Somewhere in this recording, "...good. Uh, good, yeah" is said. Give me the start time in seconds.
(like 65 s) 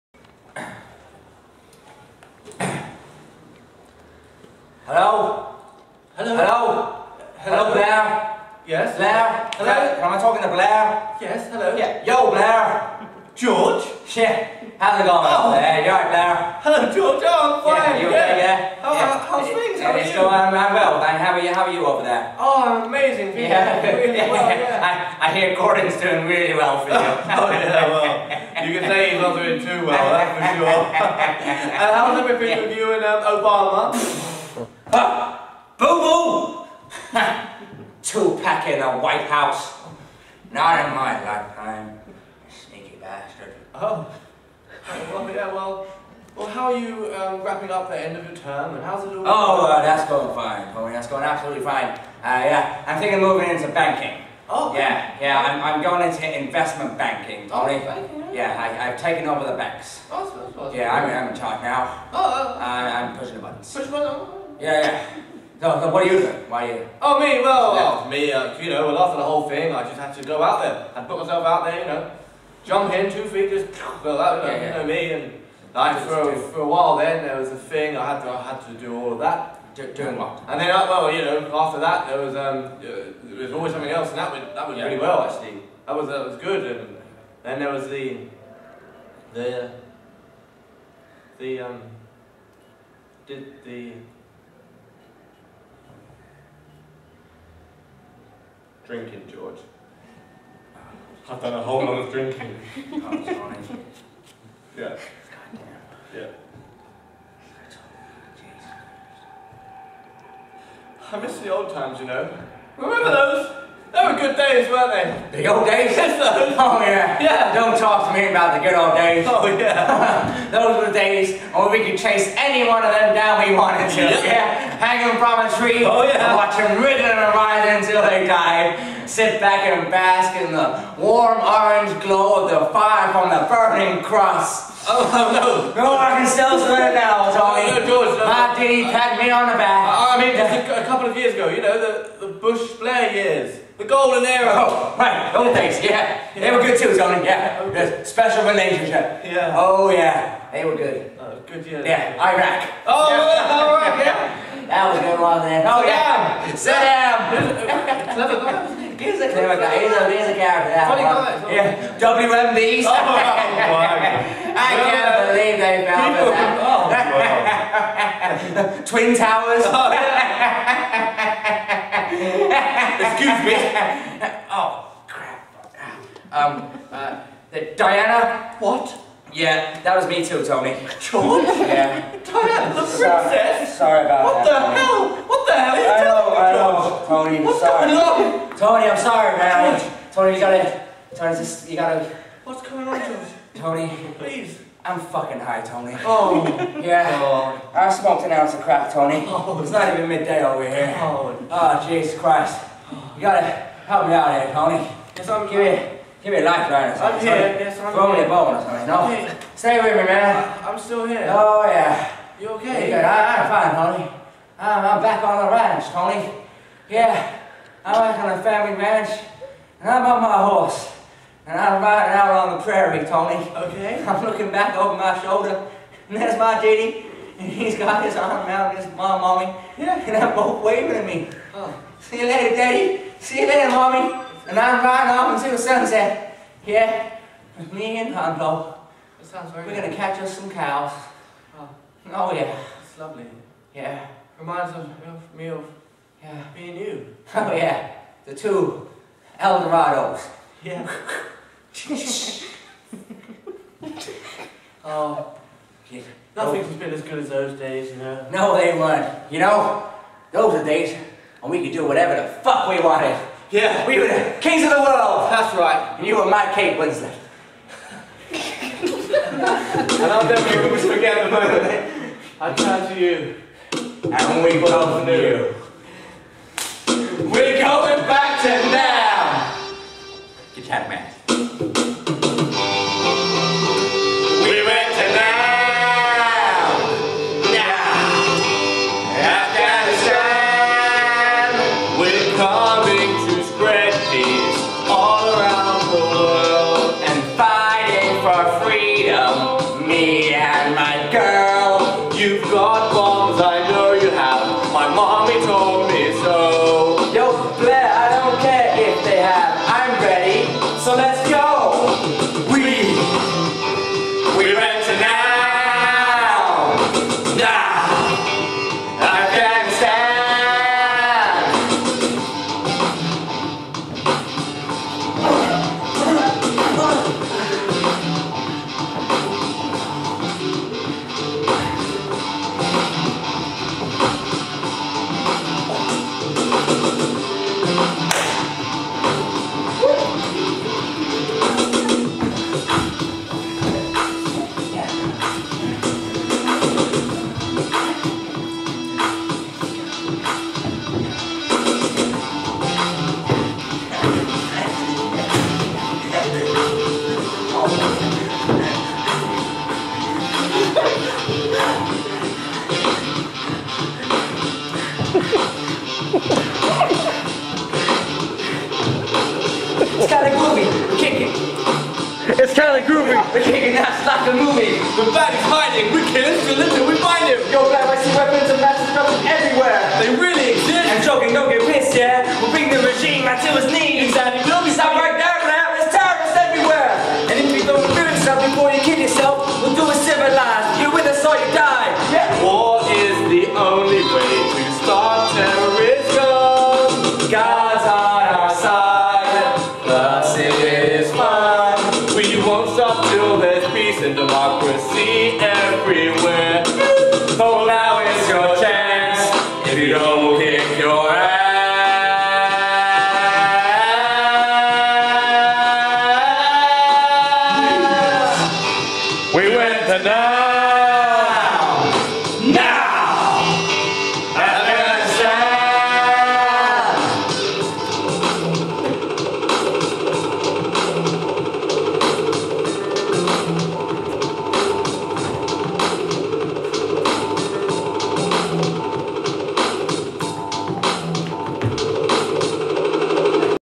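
150 s.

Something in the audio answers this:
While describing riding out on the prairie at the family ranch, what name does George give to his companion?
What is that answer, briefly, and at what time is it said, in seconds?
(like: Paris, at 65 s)
Hondo, at 238 s.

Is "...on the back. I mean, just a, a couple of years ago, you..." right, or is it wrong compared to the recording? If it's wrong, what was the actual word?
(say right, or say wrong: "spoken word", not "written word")
right.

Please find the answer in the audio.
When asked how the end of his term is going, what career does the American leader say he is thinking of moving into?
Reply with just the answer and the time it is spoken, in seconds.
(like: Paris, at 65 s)
Investment banking, at 56 s.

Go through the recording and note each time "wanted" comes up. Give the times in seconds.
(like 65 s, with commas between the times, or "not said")
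123 s, 262 s.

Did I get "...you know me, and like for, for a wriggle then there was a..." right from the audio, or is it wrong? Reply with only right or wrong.
wrong.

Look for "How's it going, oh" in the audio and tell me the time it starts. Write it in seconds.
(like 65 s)
14 s.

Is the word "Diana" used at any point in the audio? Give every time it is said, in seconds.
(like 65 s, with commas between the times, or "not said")
177 s, 182 s.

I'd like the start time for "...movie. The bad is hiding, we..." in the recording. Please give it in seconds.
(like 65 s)
374 s.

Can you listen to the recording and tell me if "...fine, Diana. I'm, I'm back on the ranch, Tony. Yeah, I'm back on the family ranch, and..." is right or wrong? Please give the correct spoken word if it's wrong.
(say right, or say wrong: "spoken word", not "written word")
wrong: "Tony", not "Diana".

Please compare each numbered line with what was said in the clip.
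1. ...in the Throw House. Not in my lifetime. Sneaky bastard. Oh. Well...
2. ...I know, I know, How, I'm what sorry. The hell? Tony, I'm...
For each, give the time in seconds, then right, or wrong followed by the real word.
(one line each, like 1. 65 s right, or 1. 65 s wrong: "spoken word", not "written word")
1. 38 s wrong: "White", not "Throw"
2. 185 s wrong: "Tony", not "How".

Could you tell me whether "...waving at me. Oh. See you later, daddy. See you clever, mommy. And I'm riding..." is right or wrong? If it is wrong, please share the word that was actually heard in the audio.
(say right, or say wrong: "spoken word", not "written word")
wrong: "later", not "clever".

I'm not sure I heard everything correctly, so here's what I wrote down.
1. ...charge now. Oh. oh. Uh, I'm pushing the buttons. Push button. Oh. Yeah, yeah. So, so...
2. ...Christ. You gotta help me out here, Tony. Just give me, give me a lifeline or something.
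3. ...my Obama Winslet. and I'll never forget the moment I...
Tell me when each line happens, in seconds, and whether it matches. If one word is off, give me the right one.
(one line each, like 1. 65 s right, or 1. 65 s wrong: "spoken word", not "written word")
1. 61 s right
2. 202 s right
3. 266 s wrong: "Kate", not "Obama".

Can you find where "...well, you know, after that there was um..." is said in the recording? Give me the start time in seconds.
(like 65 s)
80 s.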